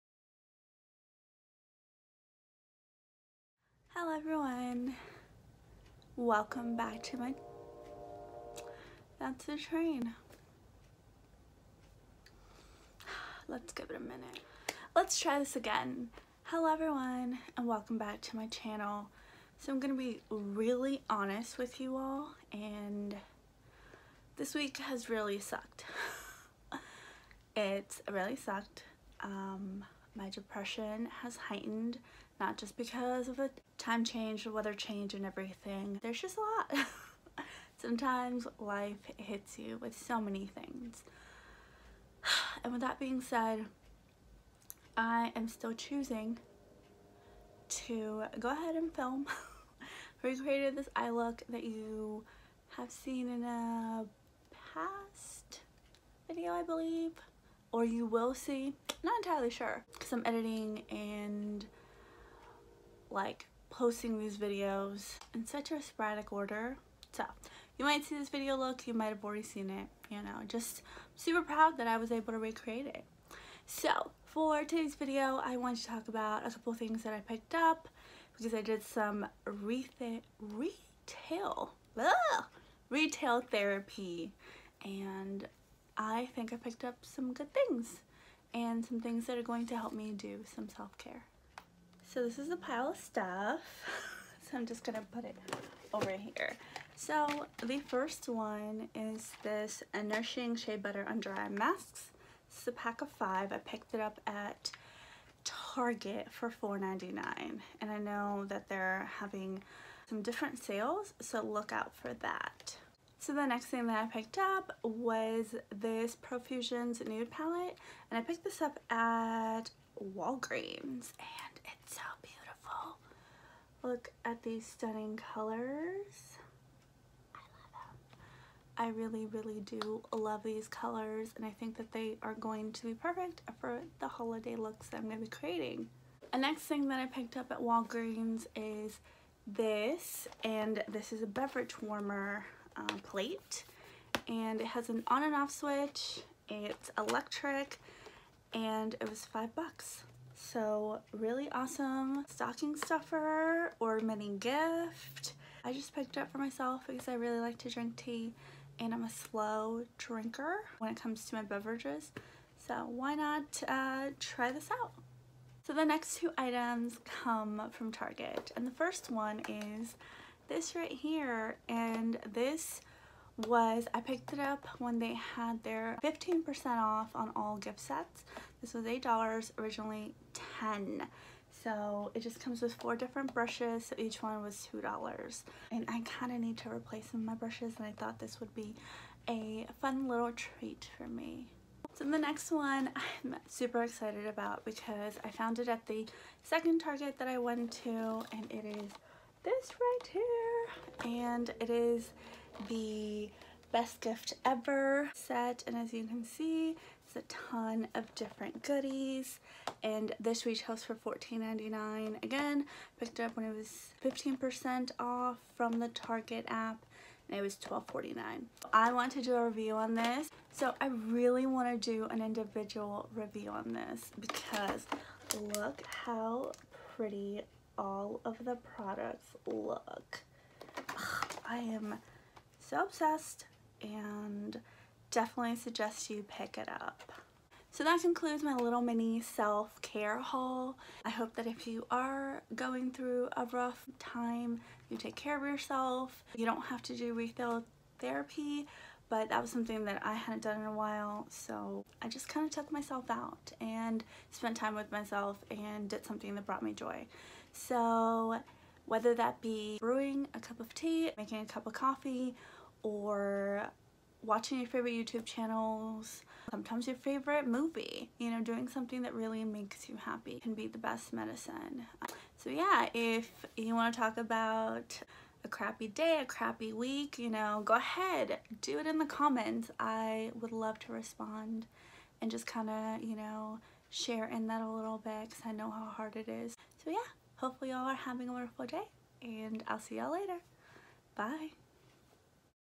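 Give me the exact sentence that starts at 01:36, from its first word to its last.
So the first one is this Nourishing Shea Butter Under Eye Masks.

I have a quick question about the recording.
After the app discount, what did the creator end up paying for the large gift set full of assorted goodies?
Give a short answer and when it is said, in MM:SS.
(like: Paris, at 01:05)
$12.49, at 03:37.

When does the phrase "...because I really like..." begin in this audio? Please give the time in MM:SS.
02:36.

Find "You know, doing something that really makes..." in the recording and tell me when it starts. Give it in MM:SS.
04:28.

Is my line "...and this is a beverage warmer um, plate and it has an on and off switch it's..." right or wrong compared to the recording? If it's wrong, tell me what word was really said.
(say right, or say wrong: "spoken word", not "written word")
right.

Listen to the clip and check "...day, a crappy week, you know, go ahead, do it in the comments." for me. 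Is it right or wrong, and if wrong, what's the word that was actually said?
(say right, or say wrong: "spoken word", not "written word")
right.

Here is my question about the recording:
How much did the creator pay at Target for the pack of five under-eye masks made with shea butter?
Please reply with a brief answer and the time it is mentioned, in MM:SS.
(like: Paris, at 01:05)
$4.99, at 01:46.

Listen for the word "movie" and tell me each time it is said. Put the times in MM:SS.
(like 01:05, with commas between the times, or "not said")
04:27.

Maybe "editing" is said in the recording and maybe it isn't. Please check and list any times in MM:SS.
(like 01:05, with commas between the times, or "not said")
01:00.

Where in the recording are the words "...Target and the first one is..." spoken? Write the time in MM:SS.
02:47.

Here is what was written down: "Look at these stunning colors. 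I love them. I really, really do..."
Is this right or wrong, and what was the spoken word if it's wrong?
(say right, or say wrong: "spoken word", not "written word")
right.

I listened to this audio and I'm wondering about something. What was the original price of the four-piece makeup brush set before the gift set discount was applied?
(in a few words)
$10.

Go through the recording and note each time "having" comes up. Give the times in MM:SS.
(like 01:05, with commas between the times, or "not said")
01:49, 04:47.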